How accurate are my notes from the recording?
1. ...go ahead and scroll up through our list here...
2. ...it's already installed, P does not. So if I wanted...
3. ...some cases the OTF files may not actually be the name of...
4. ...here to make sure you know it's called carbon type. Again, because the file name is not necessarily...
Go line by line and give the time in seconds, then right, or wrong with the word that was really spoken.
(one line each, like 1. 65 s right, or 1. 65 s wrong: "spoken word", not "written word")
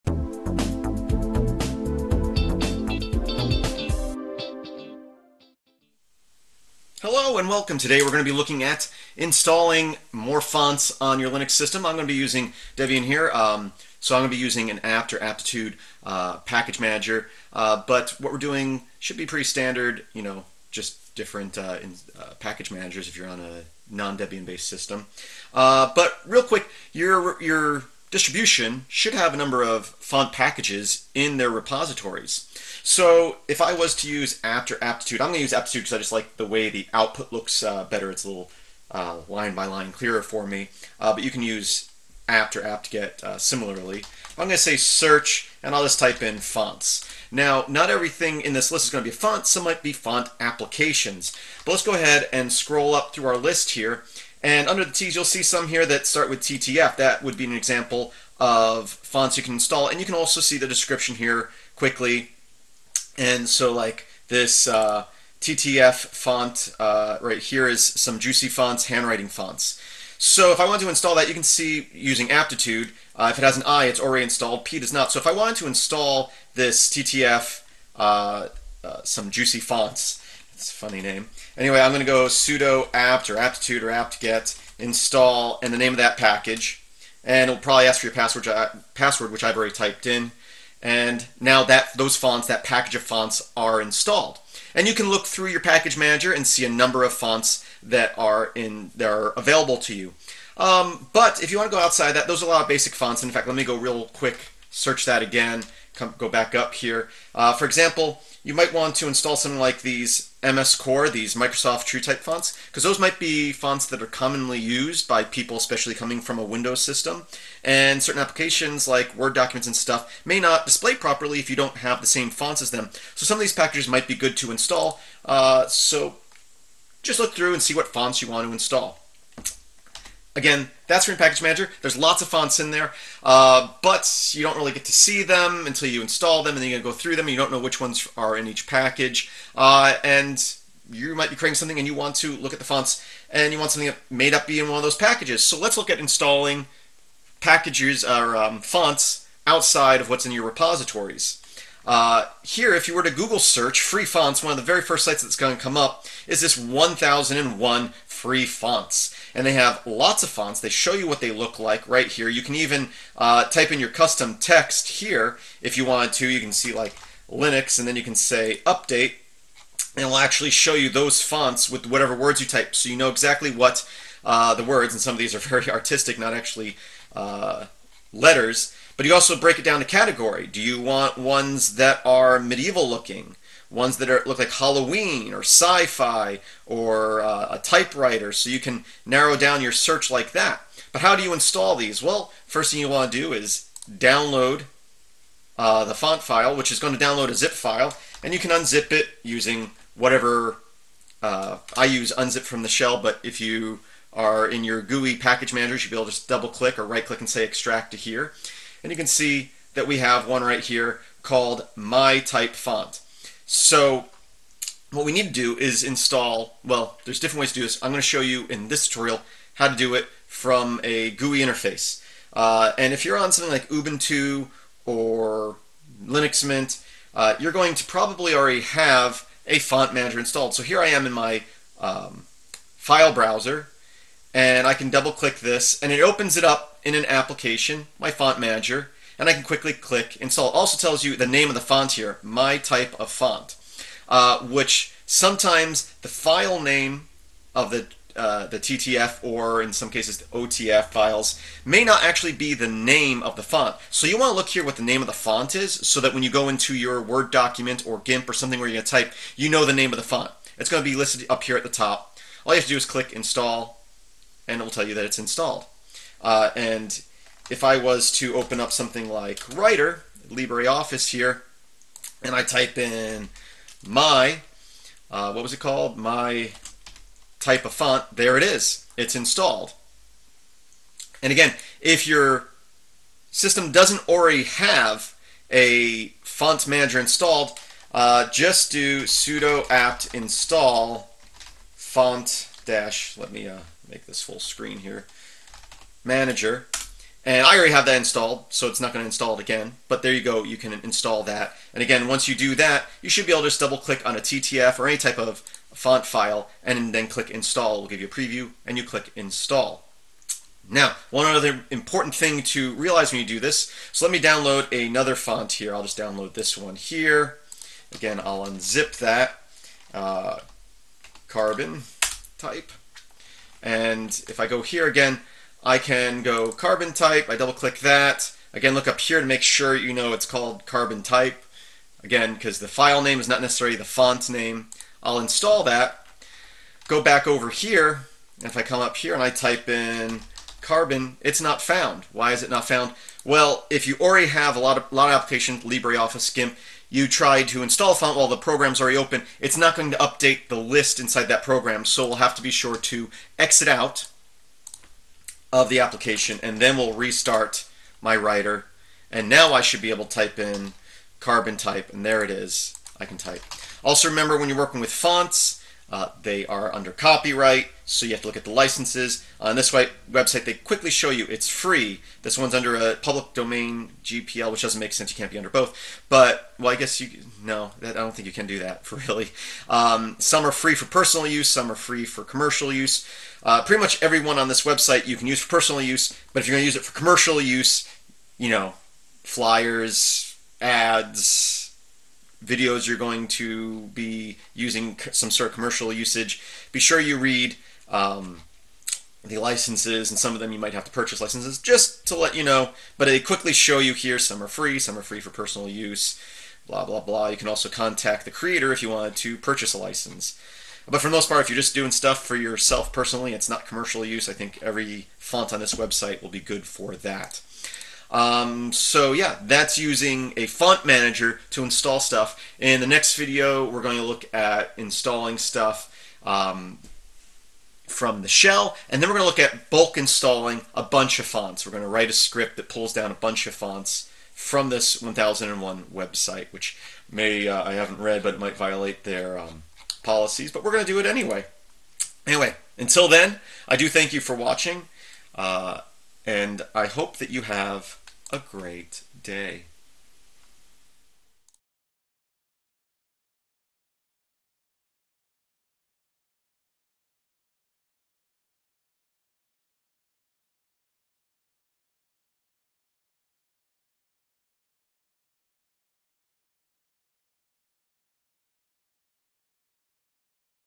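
1. 51 s right
2. 73 s right
3. 249 s right
4. 328 s right.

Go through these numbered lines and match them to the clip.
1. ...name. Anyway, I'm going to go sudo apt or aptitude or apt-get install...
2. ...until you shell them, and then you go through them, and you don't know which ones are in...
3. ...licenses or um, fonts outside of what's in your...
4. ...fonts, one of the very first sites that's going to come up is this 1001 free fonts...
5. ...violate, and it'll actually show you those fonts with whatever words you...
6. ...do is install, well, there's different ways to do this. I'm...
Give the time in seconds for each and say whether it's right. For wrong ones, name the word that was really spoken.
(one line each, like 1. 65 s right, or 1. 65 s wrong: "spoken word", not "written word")
1. 81 s right
2. 135 s wrong: "install", not "shell"
3. 147 s wrong: "packages", not "licenses"
4. 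154 s right
5. 168 s wrong: "update", not "violate"
6. 215 s right.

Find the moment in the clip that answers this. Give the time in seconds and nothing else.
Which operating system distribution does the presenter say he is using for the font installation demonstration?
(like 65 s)
12 s.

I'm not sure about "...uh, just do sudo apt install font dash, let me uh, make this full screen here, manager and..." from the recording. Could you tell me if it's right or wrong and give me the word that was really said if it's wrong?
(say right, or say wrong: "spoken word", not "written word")
right.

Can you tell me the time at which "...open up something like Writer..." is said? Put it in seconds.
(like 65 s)
268 s.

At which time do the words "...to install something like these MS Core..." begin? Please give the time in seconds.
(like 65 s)
108 s.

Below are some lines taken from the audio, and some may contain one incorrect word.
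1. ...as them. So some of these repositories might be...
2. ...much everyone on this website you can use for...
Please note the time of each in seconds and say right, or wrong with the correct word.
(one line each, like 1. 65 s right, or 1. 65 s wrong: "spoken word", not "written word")
1. 122 s wrong: "packages", not "repositories"
2. 383 s right.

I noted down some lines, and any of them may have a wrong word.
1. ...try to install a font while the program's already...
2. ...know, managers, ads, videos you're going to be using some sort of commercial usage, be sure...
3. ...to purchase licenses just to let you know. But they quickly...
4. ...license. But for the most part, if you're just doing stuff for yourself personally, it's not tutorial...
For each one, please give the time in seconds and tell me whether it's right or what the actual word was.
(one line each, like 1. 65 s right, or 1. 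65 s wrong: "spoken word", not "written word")
1. 347 s right
2. 388 s wrong: "flyers", not "managers"
3. 400 s right
4. 409 s wrong: "commercial", not "tutorial".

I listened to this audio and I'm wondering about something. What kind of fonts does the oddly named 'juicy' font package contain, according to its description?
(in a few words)
handwriting fonts.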